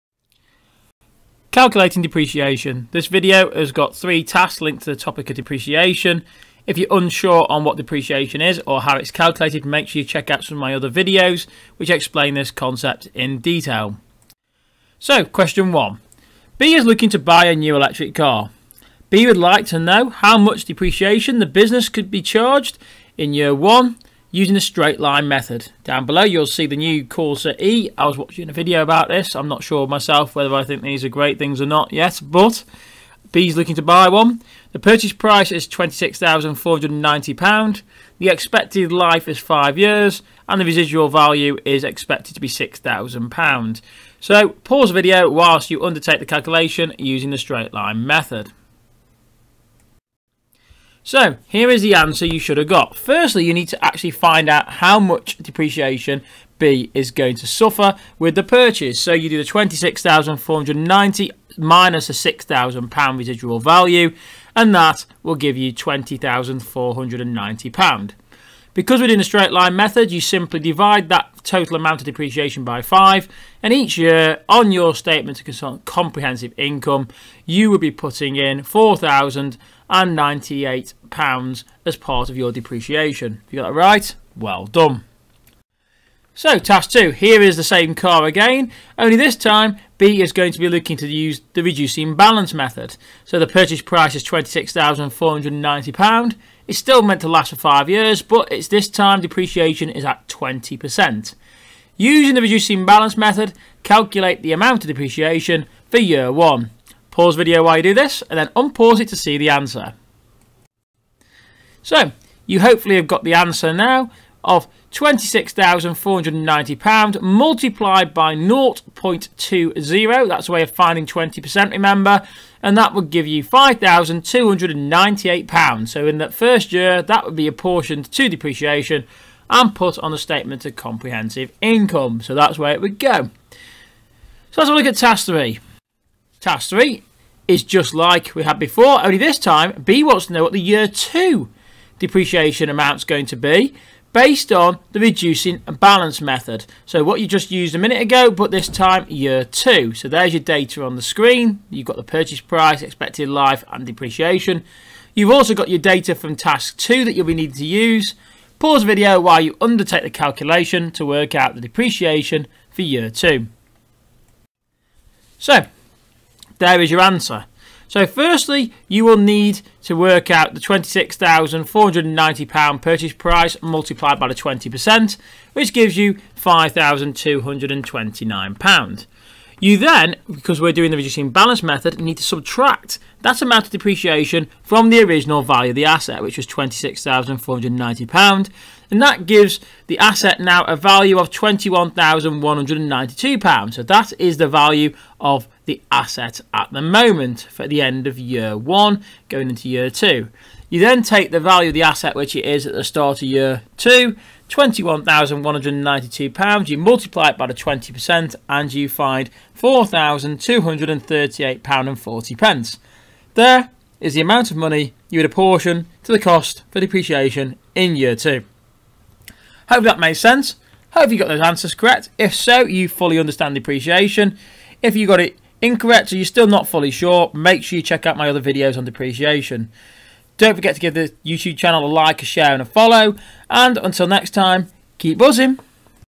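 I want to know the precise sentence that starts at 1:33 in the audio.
So the purchase price is £26,490, it's still meant to last for 5 years, but it's this time depreciation is at 20%.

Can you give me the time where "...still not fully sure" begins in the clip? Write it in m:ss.
3:46.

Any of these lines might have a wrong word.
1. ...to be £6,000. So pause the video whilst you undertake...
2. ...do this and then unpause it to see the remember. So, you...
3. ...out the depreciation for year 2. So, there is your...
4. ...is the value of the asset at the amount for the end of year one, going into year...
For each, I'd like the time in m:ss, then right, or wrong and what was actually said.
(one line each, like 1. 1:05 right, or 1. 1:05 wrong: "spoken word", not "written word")
1. 0:42 right
2. 1:47 wrong: "answer", not "remember"
3. 2:41 right
4. 3:14 wrong: "moment", not "amount".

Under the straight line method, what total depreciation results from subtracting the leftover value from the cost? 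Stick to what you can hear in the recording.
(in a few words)
£20,490.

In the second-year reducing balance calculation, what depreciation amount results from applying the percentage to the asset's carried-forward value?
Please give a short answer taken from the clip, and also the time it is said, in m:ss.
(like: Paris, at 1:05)
£4,238.40, at 3:29.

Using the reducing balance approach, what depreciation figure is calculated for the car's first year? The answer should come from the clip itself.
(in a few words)
£5,298.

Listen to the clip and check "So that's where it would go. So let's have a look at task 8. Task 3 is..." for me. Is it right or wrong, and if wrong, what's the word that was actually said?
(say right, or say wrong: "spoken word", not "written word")
wrong: "3", not "8".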